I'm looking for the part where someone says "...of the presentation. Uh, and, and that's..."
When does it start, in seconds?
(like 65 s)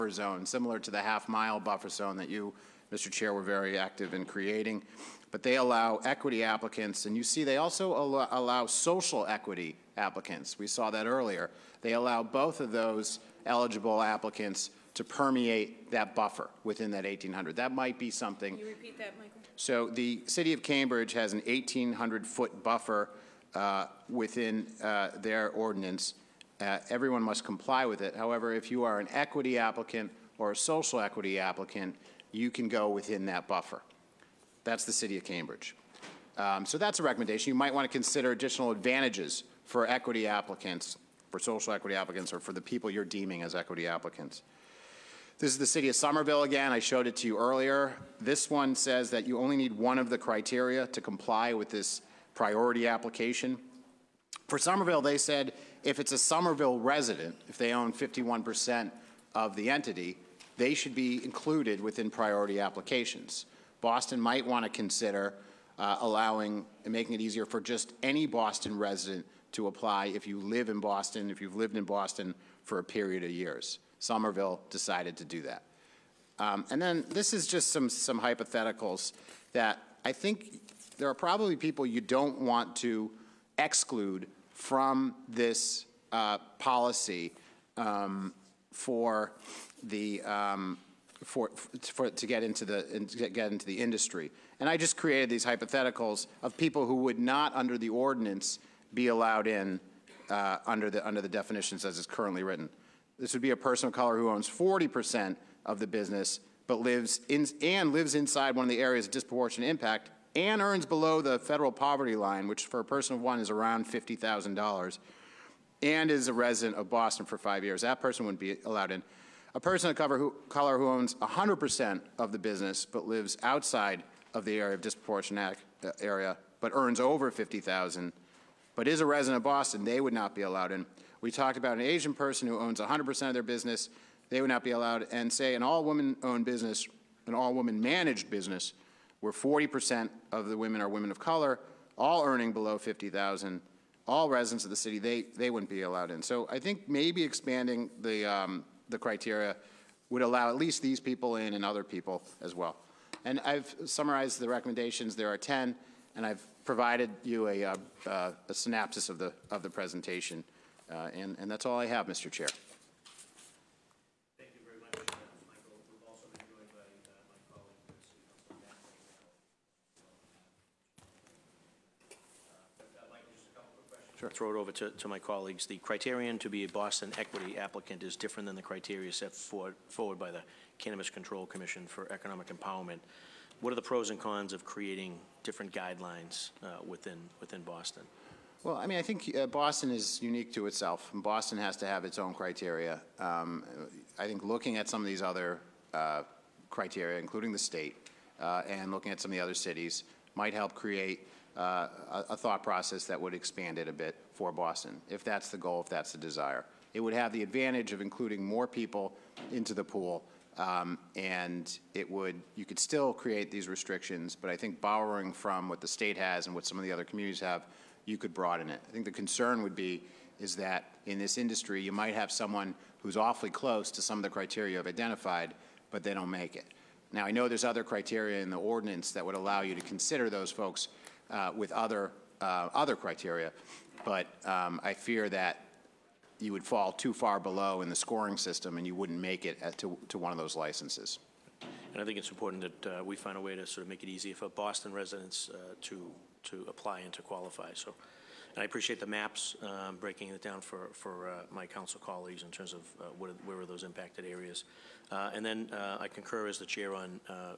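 159 s.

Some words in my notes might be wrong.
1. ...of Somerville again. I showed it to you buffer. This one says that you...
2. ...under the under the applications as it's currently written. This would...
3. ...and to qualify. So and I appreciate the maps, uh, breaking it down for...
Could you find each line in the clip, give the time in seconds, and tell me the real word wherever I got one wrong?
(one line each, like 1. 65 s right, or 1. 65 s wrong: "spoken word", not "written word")
1. 45 s wrong: "earlier", not "buffer"
2. 100 s wrong: "definitions", not "applications"
3. 247 s right.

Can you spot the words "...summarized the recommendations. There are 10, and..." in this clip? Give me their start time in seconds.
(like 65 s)
153 s.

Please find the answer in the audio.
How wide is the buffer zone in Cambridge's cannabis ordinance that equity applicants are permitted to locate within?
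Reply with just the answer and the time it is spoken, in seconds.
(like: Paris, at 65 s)
1,800 feet, at 21 s.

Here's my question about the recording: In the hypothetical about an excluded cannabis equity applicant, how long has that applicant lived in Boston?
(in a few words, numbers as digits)
5.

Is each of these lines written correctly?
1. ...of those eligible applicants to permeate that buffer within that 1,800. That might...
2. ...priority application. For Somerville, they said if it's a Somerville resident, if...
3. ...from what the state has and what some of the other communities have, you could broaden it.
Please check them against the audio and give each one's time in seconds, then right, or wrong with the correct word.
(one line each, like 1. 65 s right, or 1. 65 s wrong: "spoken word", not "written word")
1. 12 s right
2. 52 s right
3. 215 s right.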